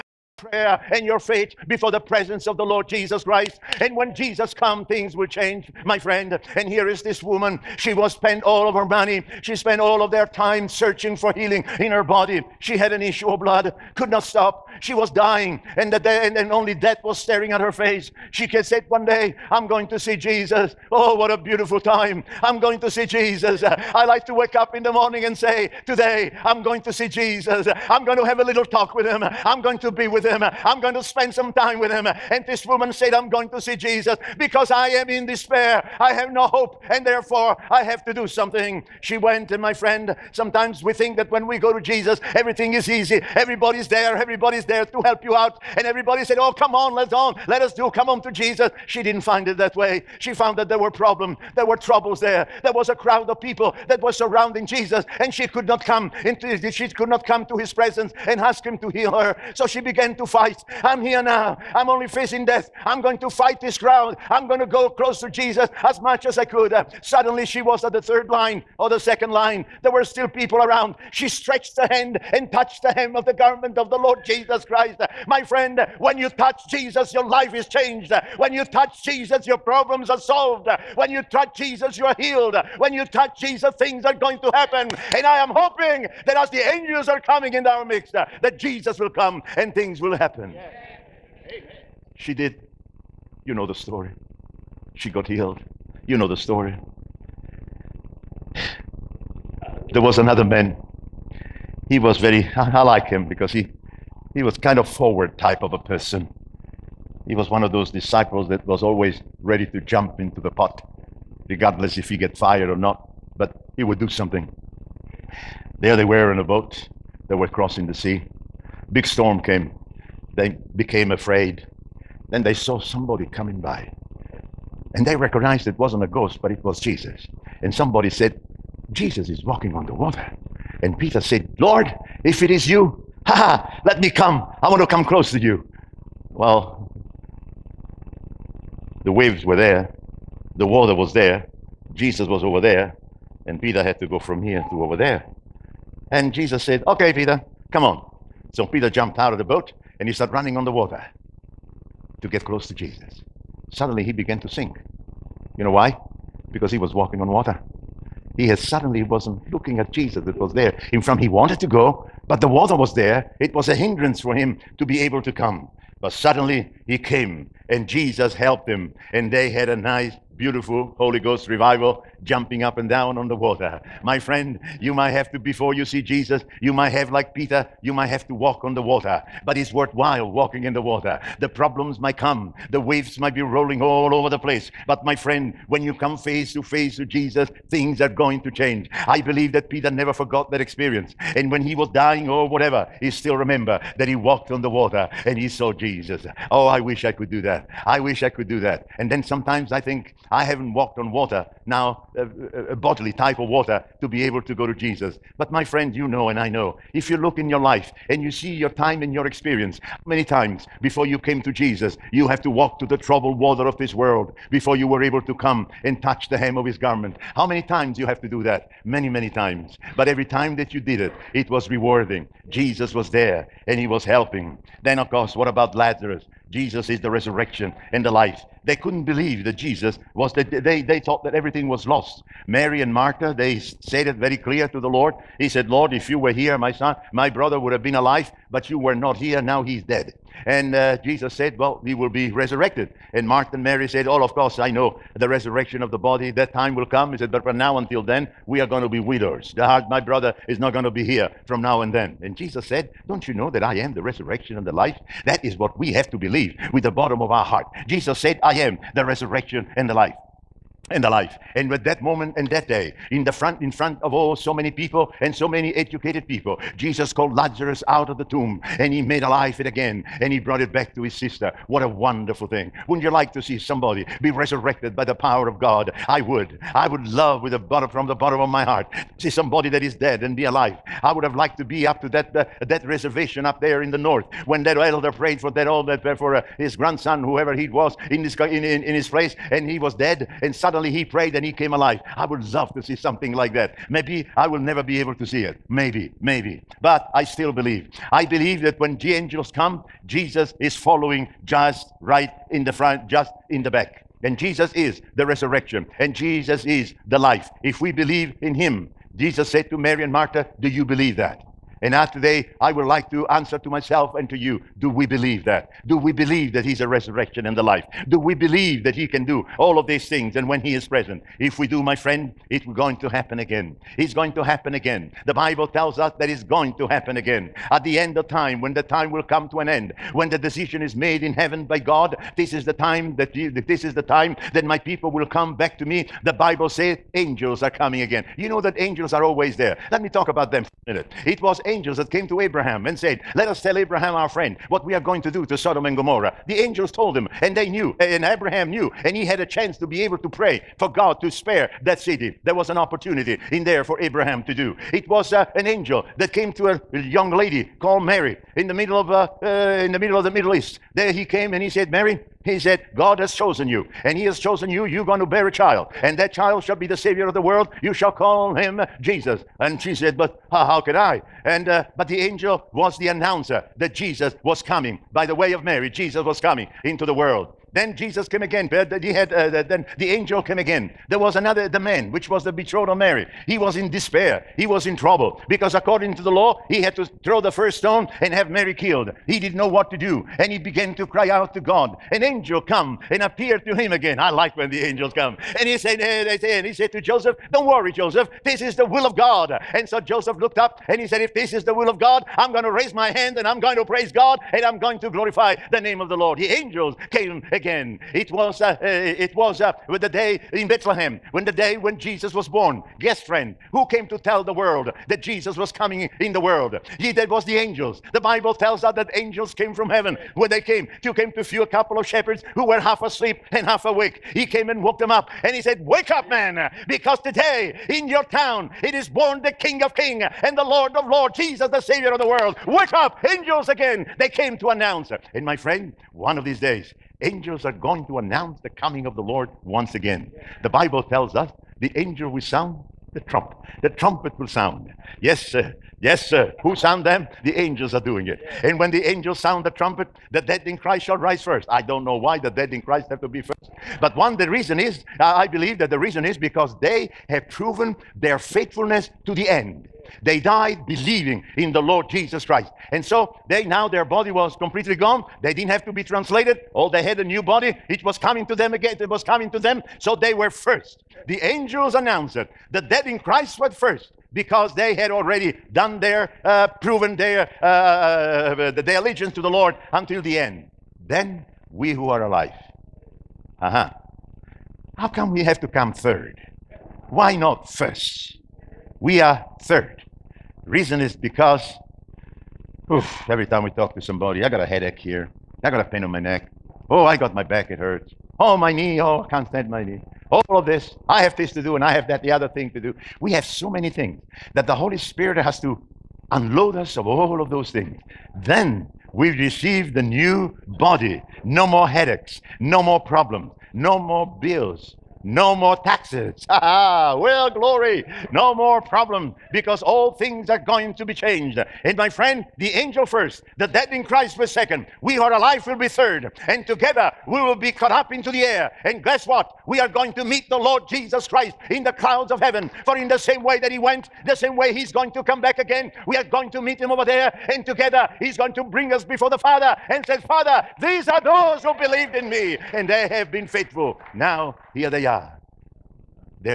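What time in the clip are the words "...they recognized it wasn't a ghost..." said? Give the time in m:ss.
2:05.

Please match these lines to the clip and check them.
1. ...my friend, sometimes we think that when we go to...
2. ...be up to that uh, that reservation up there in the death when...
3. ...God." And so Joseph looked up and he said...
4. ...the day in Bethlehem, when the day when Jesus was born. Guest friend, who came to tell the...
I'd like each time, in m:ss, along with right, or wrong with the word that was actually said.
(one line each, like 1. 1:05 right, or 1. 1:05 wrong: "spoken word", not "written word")
1. 0:39 right
2. 4:41 wrong: "north", not "death"
3. 6:39 right
4. 6:50 right.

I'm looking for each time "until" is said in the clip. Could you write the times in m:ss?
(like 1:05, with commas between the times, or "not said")
4:07, 7:59.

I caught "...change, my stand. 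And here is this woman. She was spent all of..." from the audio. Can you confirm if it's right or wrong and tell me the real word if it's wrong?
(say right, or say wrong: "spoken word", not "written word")
wrong: "friend", not "stand".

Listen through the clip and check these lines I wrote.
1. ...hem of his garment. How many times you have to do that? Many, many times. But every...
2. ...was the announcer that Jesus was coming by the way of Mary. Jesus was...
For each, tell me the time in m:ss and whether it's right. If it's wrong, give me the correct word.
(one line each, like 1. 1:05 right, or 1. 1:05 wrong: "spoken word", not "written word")
1. 3:36 right
2. 6:12 right.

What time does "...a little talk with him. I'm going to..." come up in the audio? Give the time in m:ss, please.
0:28.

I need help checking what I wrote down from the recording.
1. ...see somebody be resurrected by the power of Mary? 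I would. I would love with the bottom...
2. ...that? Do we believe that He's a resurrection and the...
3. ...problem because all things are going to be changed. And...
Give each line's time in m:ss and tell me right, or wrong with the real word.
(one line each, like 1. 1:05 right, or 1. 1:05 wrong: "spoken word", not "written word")
1. 4:33 wrong: "God", not "Mary"
2. 5:15 right
3. 8:38 right.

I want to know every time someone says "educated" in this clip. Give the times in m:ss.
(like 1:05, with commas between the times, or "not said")
4:25.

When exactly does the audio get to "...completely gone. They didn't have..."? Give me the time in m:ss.
7:44.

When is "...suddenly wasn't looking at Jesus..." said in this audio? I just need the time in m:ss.
2:38.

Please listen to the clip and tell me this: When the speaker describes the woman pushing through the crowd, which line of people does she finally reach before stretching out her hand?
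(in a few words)
the second line.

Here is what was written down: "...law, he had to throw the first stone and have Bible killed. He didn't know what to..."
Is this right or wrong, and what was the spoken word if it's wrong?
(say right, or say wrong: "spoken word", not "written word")
wrong: "Mary", not "Bible".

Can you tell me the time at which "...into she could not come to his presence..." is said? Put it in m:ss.
0:56.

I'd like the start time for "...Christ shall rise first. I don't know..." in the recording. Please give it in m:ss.
7:30.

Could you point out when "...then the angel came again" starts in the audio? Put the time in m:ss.
6:19.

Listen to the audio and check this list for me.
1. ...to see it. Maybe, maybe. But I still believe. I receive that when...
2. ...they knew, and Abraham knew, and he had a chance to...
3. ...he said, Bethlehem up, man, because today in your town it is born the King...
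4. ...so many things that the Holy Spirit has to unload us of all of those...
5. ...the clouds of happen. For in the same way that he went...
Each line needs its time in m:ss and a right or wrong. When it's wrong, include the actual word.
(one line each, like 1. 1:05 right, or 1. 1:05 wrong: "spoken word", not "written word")
1. 4:55 wrong: "believe", not "receive"
2. 5:47 right
3. 7:05 wrong: "Wake", not "Bethlehem"
4. 8:23 right
5. 8:51 wrong: "heaven", not "happen".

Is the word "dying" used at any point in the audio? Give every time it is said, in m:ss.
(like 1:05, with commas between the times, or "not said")
0:15, 3:11.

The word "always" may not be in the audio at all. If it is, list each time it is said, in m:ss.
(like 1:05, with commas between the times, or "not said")
1:48, 5:39.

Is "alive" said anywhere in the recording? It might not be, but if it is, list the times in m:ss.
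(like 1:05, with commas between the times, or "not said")
3:57, 4:21, 4:29, 4:40, 4:51, 8:02, 8:45.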